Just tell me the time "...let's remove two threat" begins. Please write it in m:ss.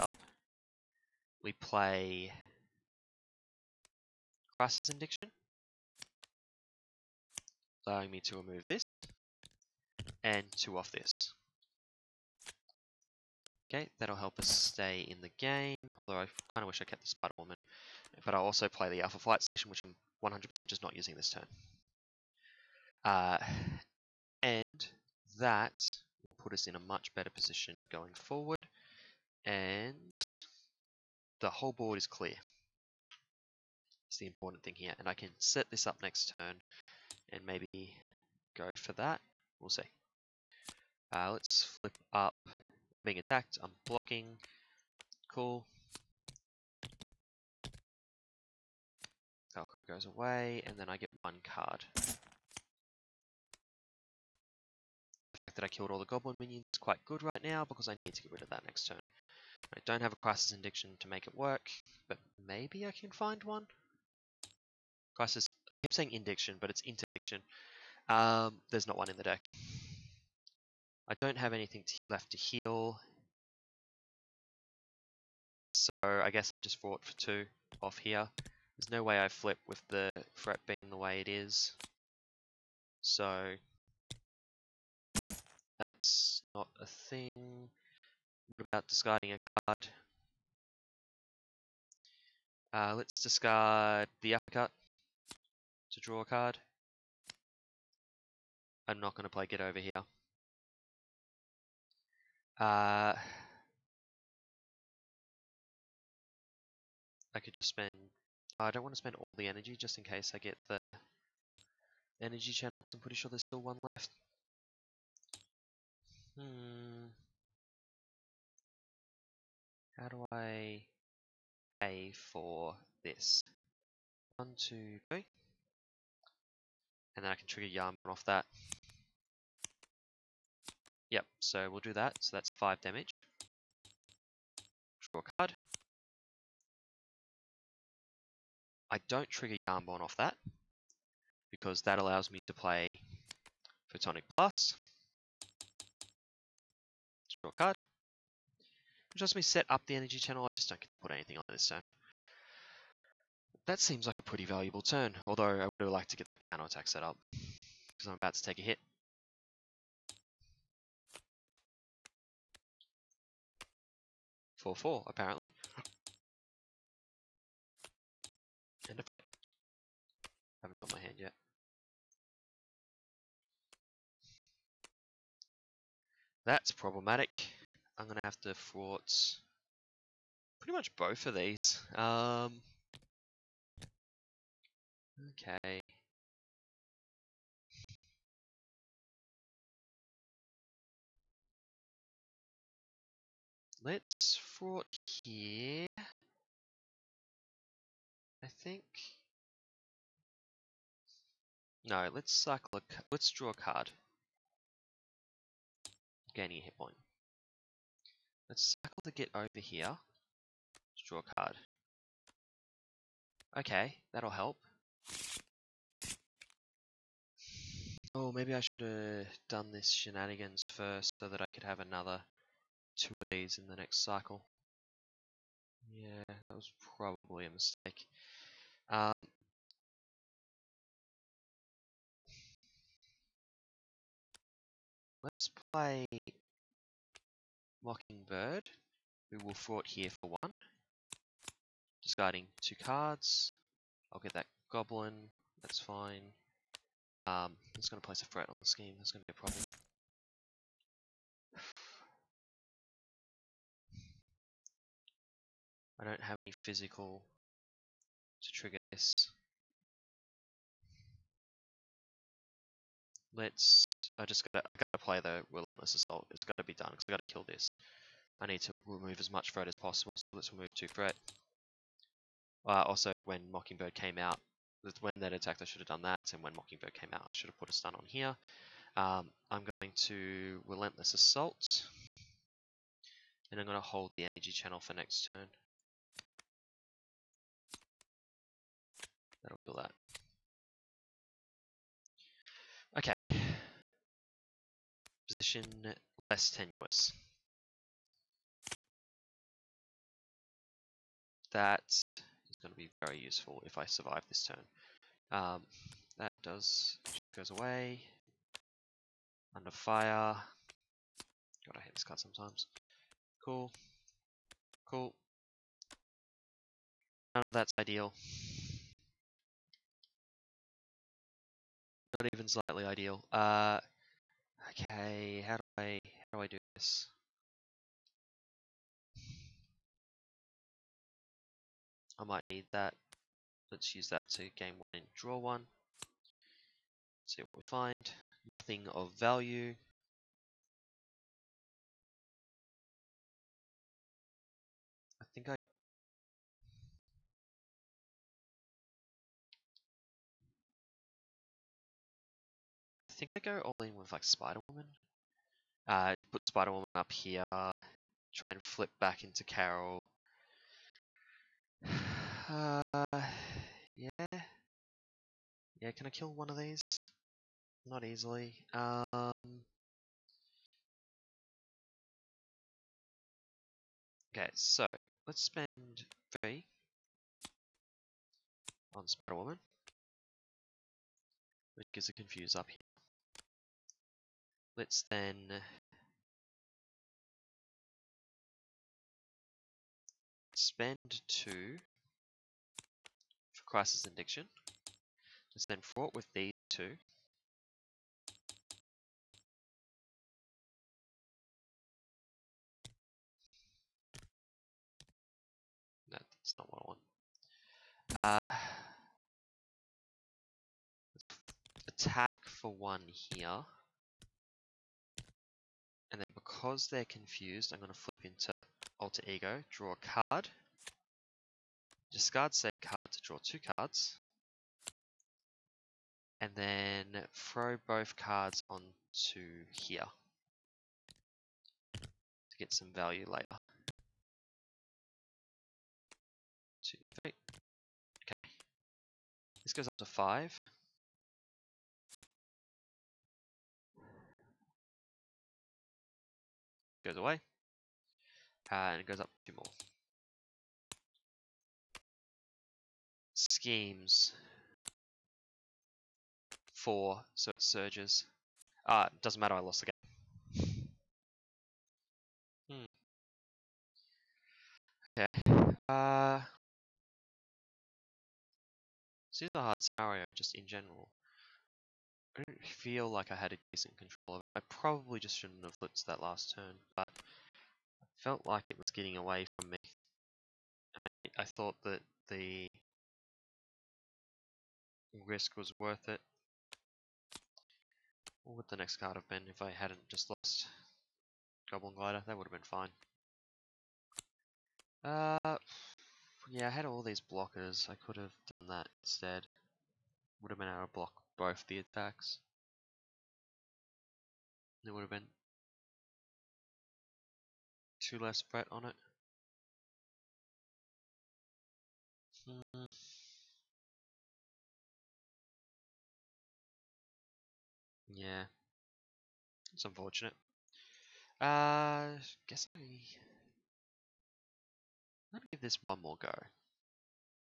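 4:30.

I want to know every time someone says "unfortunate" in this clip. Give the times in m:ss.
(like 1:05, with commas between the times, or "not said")
8:39.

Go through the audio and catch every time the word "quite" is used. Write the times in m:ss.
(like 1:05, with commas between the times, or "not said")
0:56.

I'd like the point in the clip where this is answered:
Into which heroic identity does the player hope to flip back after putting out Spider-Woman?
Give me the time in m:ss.
5:59.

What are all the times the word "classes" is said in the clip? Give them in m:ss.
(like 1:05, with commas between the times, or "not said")
6:33.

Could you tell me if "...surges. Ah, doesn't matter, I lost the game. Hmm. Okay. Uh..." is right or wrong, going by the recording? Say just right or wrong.
right.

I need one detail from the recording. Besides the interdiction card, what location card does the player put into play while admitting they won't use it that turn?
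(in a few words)
Alpha Flight Station.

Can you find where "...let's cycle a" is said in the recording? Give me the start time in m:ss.
3:22.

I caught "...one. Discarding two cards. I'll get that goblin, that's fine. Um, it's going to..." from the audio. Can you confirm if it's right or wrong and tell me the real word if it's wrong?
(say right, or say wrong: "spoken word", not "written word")
right.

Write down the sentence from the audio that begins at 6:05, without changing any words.
Yeah, can I kill one of these?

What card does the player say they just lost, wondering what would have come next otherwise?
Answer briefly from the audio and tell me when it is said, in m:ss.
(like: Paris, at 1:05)
Goblin Glider, at 8:11.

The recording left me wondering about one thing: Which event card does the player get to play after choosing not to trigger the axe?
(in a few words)
Photonic Blast.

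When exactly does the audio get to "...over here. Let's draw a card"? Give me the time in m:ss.
3:29.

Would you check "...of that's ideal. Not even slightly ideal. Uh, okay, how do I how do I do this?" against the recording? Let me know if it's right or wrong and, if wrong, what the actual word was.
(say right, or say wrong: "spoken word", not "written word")
right.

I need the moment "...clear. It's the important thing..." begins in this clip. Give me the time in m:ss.
0:32.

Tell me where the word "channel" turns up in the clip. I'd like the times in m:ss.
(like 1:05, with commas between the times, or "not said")
1:52, 2:30, 4:44.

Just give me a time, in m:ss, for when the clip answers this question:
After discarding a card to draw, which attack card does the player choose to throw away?
1:34.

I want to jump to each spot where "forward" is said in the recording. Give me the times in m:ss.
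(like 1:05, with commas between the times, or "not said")
0:28.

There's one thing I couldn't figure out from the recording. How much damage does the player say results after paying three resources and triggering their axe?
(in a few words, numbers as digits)
5.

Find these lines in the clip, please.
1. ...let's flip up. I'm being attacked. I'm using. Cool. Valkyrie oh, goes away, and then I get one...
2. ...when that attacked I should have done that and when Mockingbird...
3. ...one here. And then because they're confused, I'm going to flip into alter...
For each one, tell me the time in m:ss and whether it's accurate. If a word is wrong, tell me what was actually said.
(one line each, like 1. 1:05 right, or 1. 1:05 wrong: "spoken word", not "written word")
1. 0:41 wrong: "blocking", not "using"
2. 4:35 right
3. 6:52 right.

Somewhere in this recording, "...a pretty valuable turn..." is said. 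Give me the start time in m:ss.
2:34.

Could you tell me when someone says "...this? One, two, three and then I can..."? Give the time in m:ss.
2:03.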